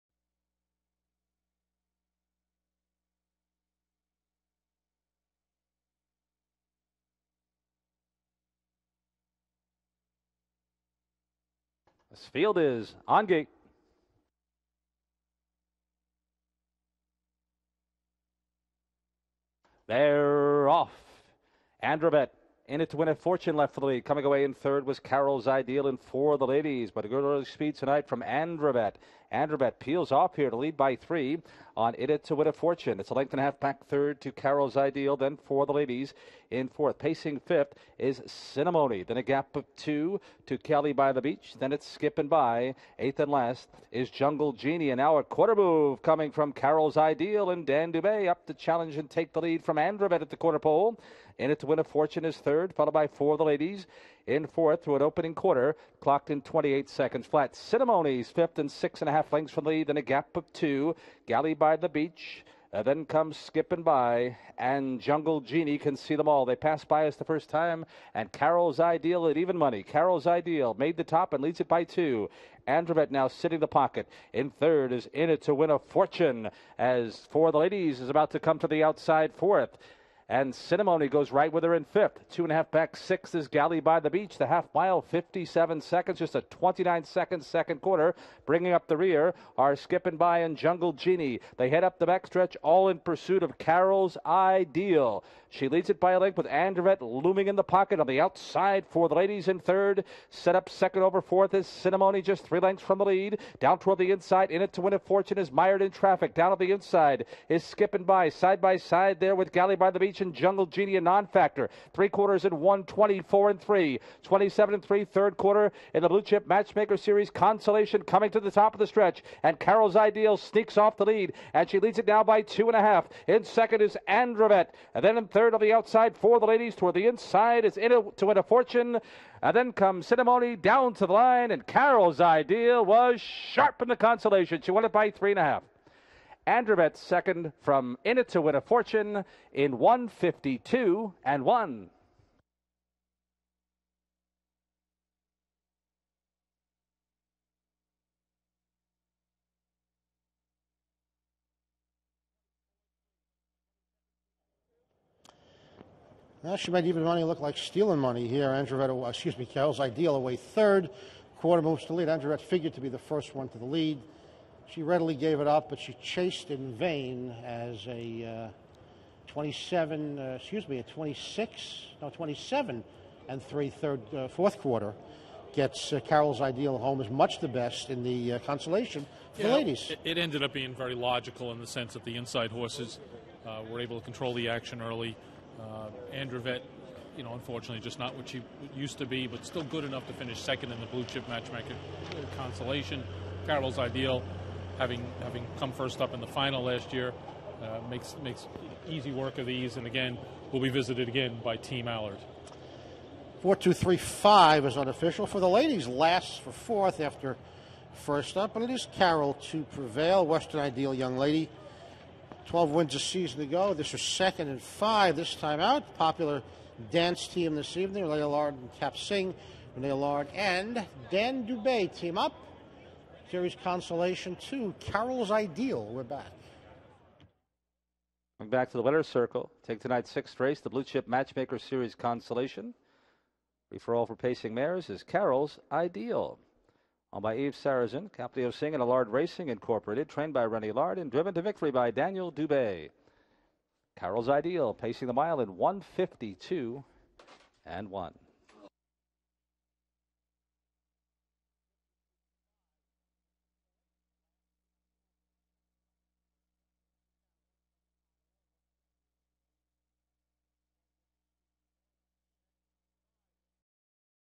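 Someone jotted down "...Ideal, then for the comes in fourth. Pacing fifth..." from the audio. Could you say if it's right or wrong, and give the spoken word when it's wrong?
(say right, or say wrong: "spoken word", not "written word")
wrong: "ladies", not "comes".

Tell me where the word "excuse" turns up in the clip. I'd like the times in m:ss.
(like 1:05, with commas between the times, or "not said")
2:39, 2:50.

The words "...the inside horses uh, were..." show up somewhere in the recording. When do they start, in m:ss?
3:02.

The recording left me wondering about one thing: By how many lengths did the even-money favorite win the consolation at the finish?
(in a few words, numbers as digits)
3 and a half.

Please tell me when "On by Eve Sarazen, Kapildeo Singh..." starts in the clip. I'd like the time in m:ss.
3:57.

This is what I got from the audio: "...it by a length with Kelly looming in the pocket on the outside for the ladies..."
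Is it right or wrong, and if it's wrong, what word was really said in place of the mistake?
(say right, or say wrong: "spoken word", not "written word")
wrong: "Andrevette", not "Kelly".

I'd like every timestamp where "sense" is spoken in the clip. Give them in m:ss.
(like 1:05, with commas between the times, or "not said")
3:01.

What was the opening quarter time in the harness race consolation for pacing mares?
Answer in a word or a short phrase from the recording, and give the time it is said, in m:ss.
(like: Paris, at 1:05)
28 seconds flat, at 0:56.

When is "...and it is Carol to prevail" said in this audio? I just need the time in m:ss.
3:28.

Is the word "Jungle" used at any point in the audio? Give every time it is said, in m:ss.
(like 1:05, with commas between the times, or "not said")
0:44, 1:05, 1:30, 1:50.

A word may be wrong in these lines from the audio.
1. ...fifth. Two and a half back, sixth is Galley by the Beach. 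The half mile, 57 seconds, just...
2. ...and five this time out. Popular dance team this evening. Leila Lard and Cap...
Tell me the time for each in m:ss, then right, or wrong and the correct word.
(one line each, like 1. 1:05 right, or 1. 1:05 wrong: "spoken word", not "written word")
1. 1:21 right
2. 3:34 right.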